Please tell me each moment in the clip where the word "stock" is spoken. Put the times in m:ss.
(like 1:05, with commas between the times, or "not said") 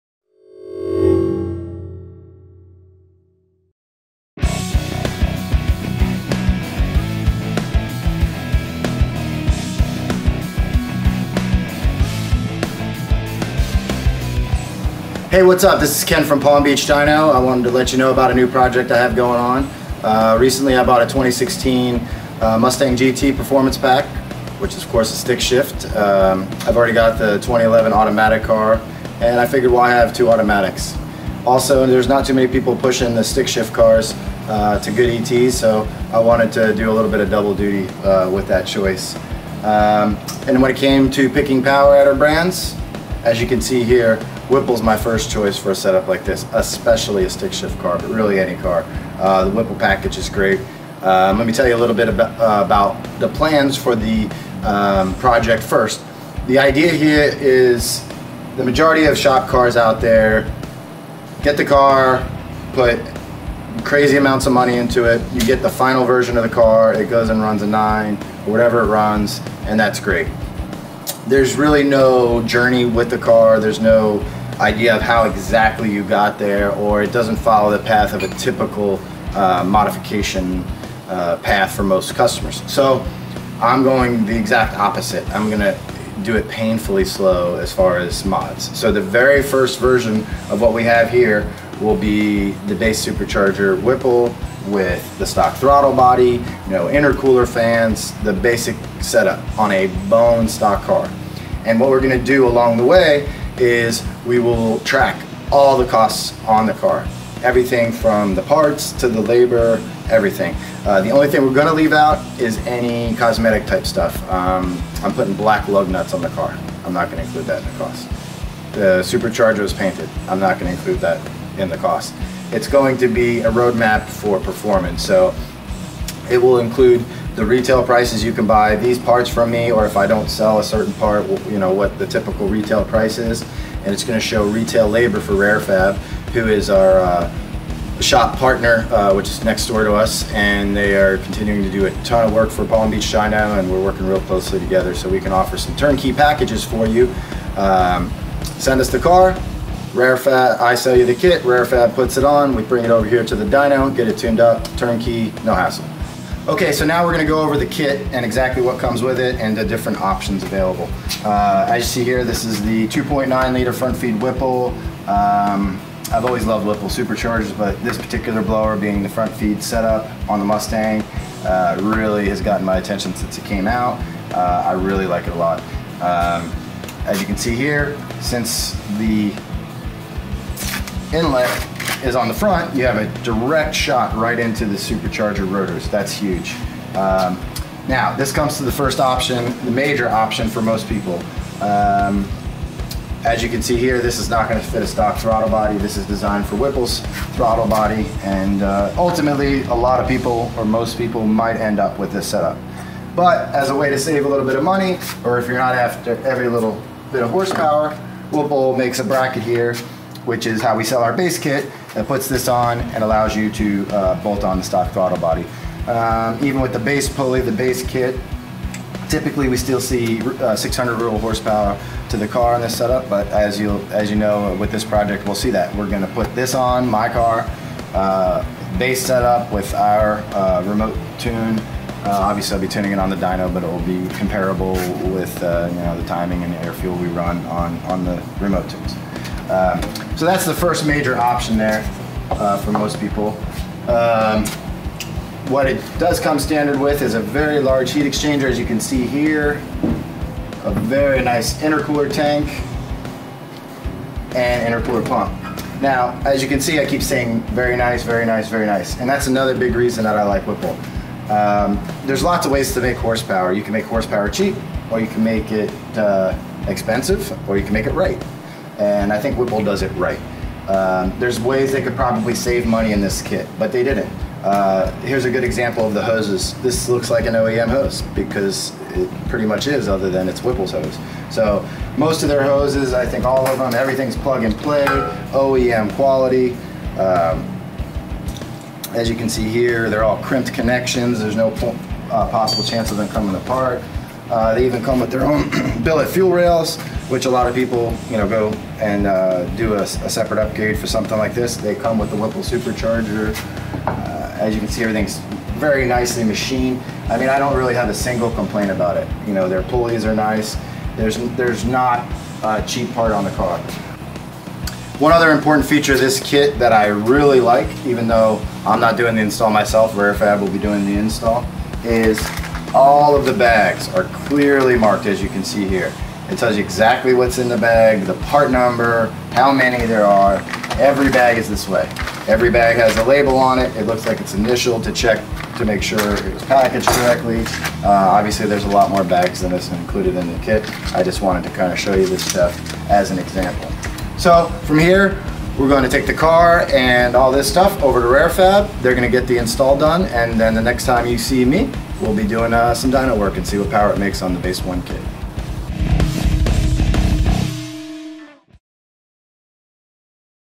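1:35, 1:40, 3:14, 3:34.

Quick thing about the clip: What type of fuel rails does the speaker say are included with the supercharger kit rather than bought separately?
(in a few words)
billet fuel rails.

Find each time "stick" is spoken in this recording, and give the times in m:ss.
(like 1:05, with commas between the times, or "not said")
0:25, 0:33, 0:47.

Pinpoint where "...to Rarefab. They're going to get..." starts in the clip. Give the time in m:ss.
5:48.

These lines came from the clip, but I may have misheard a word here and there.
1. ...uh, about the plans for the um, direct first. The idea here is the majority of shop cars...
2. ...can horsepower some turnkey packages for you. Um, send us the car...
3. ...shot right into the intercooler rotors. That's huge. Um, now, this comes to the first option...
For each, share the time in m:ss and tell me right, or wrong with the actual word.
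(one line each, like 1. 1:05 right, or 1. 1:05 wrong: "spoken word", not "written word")
1. 0:52 wrong: "project", not "direct"
2. 2:25 wrong: "offer", not "horsepower"
3. 3:03 wrong: "supercharger", not "intercooler".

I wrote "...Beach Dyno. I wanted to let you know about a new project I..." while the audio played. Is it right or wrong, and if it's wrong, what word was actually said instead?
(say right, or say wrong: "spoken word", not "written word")
right.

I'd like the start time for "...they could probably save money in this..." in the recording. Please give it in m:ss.
4:31.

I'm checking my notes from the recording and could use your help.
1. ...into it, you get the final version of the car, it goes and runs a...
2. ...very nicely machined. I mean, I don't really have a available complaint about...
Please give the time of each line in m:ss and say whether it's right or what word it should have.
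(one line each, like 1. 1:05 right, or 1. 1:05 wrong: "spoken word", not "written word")
1. 1:04 right
2. 5:05 wrong: "single", not "available".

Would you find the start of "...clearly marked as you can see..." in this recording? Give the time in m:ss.
5:24.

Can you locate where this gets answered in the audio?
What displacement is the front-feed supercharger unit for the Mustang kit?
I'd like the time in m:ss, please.
2:42.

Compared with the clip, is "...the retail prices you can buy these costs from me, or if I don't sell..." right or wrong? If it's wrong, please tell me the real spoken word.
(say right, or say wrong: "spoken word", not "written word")
wrong: "parts", not "costs".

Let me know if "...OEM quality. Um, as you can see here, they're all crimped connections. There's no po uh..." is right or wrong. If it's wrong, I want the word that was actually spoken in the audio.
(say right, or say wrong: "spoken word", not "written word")
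right.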